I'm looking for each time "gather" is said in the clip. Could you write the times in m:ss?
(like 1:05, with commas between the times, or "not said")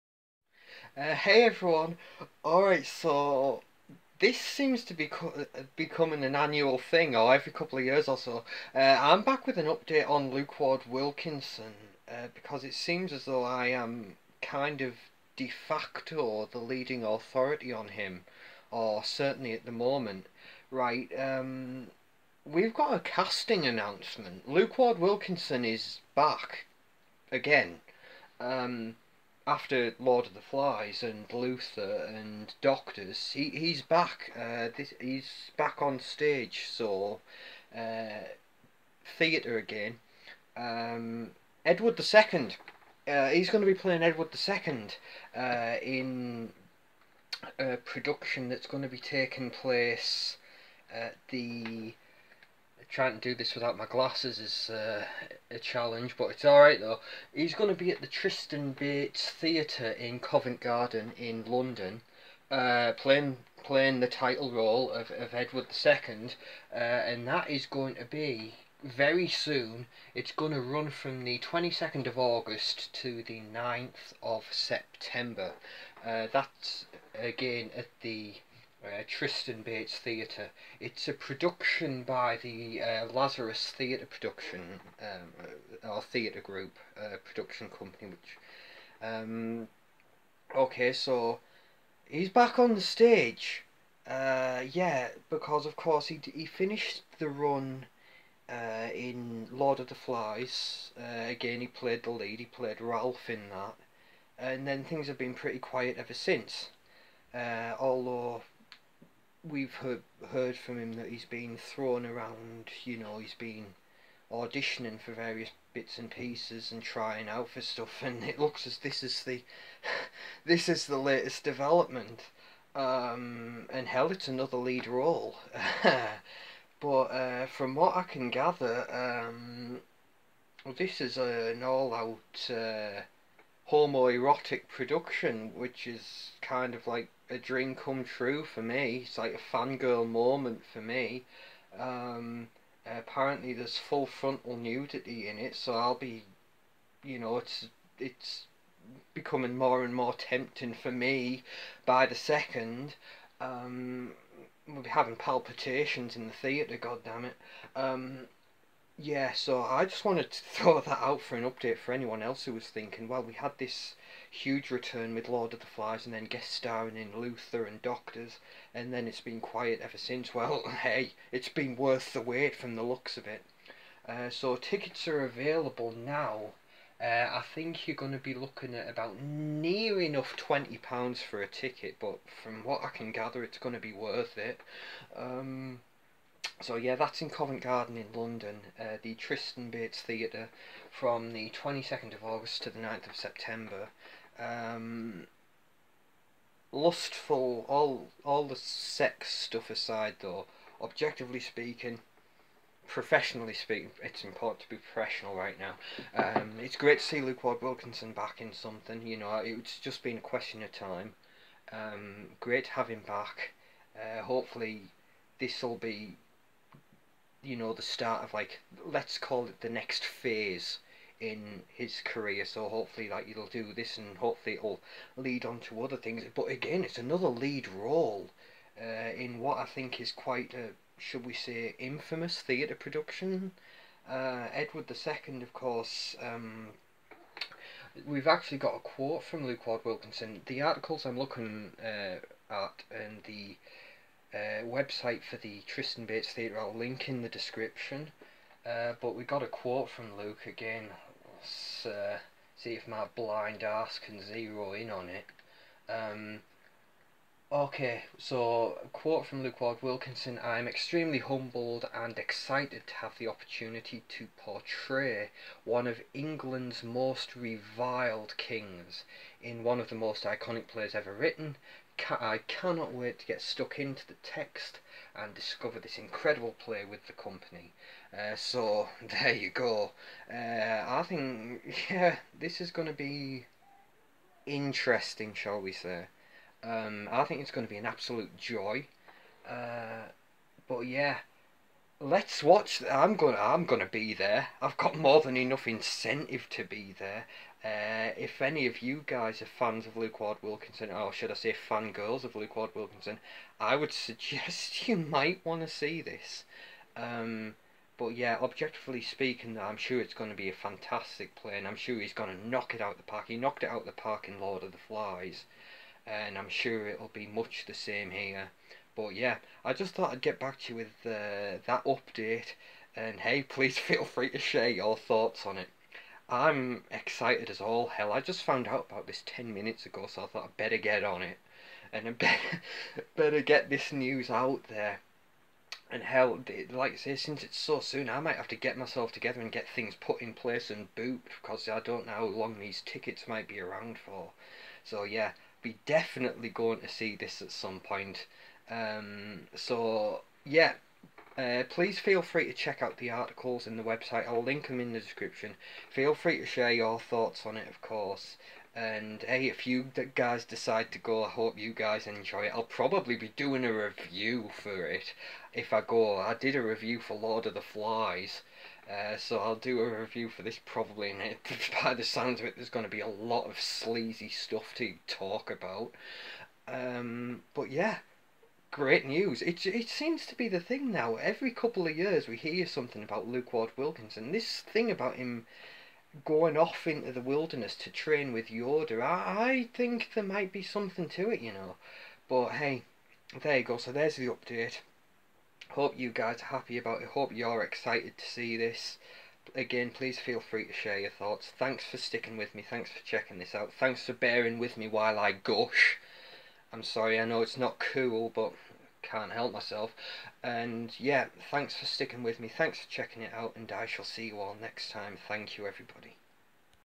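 2:08, 3:03.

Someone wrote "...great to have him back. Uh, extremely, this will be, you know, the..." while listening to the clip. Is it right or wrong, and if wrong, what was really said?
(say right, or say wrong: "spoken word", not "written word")
wrong: "hopefully", not "extremely".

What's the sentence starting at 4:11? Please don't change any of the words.
Let's uh, see if my blind ass can zero in on it.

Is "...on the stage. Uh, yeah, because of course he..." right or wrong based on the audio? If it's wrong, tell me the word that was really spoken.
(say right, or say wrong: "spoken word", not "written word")
right.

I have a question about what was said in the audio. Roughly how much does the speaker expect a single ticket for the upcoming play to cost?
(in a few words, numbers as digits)
£20.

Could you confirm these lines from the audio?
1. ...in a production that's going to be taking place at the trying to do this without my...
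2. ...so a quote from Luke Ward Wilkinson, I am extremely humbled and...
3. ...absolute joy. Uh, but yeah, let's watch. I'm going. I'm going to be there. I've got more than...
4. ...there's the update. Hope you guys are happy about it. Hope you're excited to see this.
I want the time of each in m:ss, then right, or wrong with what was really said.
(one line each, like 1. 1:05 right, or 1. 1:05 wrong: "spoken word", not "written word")
1. 0:45 right
2. 4:18 right
3. 4:47 right
4. 6:33 right.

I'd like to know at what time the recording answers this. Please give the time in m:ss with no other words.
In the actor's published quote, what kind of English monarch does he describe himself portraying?
4:27.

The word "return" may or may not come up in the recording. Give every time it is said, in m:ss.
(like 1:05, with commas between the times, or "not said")
2:44.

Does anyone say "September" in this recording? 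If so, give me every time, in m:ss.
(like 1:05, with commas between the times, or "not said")
1:14, 3:13.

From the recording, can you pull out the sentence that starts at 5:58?
And hey, if you guys decide to go, I hope you guys enjoy it.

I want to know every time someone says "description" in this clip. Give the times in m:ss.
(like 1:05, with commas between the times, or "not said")
4:07, 5:54.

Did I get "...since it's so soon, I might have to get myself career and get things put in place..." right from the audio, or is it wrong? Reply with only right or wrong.
wrong.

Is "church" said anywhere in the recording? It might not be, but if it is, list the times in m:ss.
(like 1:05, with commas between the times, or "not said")
not said.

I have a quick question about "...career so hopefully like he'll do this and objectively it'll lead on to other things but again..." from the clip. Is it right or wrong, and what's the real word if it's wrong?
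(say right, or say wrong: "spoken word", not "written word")
wrong: "hopefully", not "objectively".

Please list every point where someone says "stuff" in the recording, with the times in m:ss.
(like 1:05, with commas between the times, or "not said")
1:57, 3:19, 6:14.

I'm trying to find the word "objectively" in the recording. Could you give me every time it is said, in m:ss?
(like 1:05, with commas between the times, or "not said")
3:20, 5:08.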